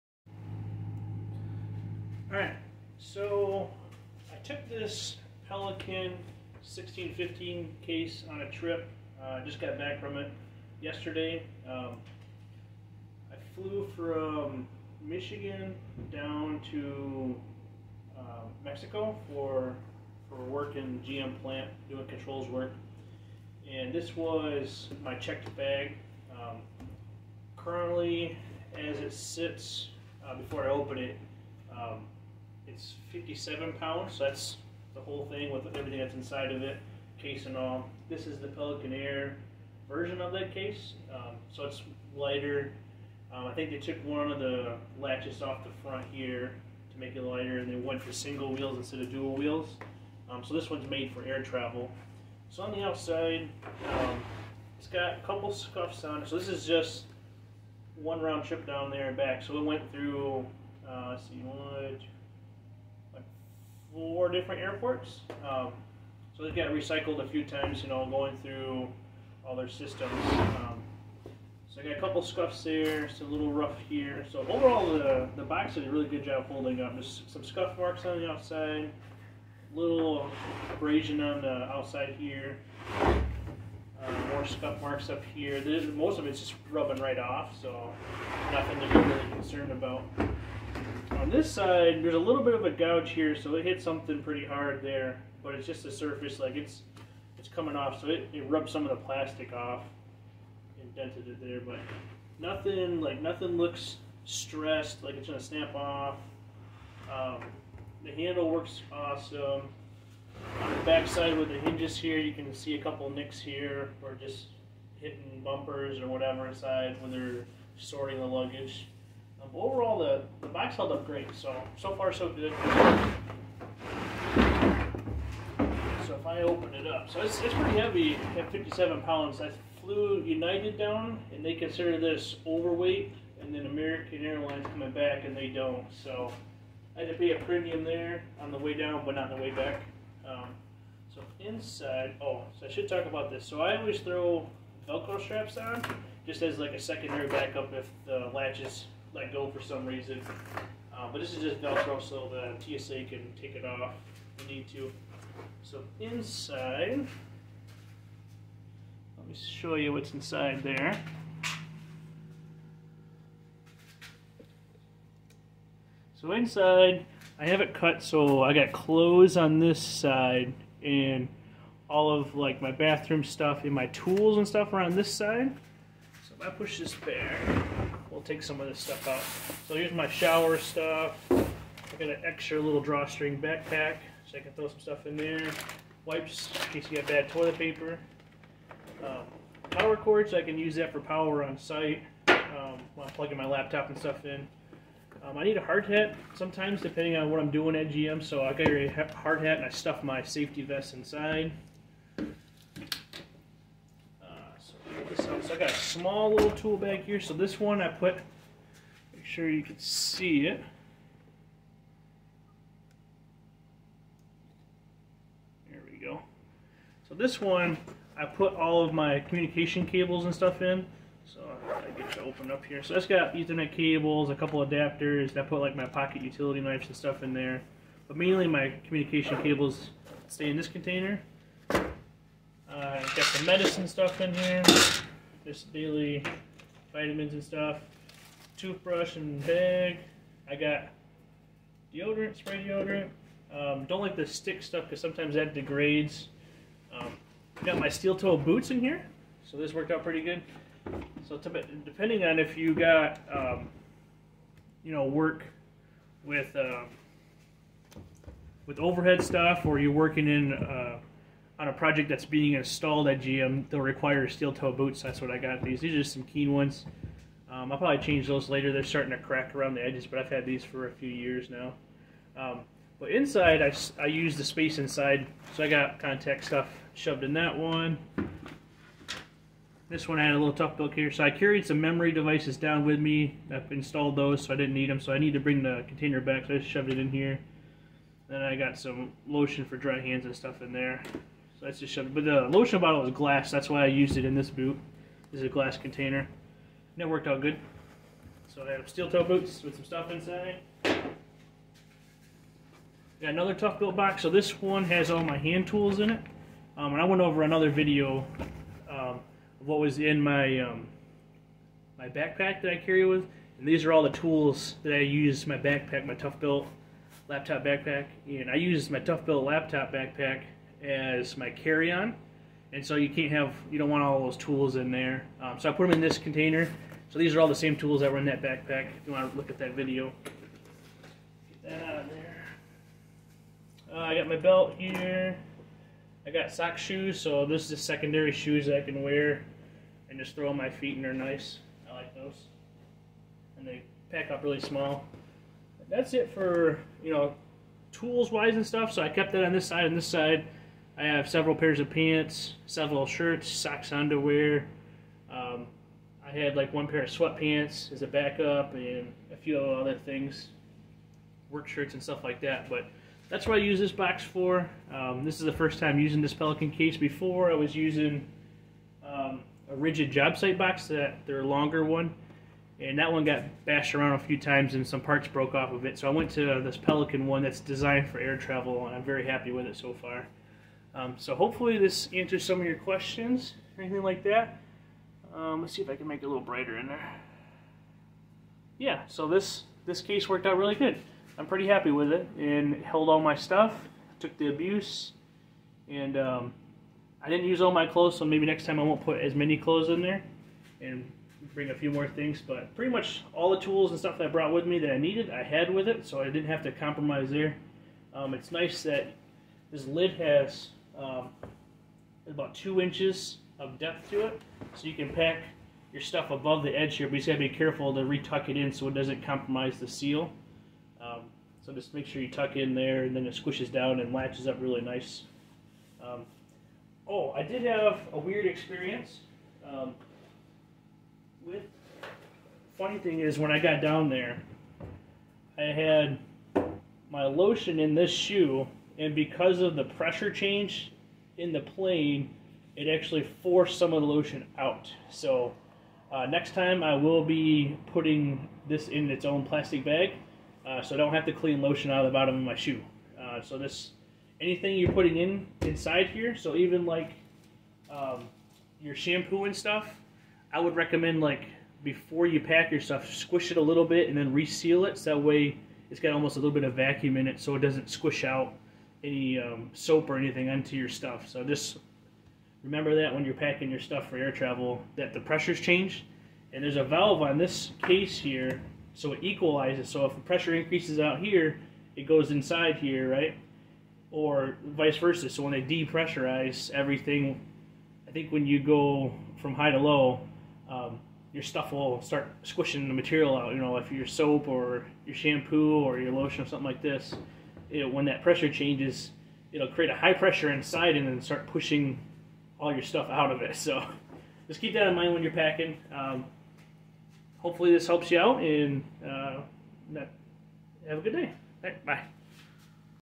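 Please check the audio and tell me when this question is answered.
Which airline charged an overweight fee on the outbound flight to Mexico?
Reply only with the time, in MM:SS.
02:10.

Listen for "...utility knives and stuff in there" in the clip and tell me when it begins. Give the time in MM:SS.
03:46.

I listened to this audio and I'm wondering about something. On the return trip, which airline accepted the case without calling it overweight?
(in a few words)
American Airlines.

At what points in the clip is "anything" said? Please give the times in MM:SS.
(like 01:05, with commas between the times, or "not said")
06:23, 07:34, 07:50.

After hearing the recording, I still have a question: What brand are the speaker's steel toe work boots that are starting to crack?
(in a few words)
Keen.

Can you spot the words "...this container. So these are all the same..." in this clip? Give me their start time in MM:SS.
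05:26.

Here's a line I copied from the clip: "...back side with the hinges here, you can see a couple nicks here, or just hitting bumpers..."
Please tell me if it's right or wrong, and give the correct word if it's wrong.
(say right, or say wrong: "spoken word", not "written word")
right.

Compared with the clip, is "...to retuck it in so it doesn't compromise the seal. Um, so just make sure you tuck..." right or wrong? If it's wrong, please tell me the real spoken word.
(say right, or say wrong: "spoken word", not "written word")
right.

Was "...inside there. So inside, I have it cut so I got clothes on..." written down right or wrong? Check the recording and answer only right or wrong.
right.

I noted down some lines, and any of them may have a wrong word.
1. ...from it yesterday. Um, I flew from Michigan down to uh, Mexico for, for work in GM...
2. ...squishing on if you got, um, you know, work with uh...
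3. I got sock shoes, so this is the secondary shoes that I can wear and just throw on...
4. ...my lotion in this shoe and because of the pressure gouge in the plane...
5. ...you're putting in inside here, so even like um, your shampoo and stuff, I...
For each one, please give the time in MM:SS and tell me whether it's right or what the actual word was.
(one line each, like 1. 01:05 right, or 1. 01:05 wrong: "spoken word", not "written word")
1. 00:09 right
2. 04:11 wrong: "depending", not "squishing"
3. 05:36 right
4. 07:17 wrong: "change", not "gouge"
5. 07:34 right.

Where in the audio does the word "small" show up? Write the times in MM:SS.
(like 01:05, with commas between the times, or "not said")
03:25, 05:44.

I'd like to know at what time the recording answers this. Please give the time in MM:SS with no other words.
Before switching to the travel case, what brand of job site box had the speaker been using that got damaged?
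06:09.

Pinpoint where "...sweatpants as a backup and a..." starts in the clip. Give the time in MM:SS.
05:57.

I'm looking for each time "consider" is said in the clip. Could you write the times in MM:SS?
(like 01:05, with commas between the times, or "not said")
02:11.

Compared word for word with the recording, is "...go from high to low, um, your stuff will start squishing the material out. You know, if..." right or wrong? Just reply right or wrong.
right.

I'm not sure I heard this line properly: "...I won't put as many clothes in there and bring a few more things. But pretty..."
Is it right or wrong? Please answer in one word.
right.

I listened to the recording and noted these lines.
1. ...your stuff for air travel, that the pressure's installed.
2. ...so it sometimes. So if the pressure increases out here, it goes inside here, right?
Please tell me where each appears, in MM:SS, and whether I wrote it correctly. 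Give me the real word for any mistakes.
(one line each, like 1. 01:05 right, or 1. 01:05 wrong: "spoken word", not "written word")
1. 07:53 wrong: "changed", not "installed"
2. 07:58 wrong: "equalizes", not "sometimes".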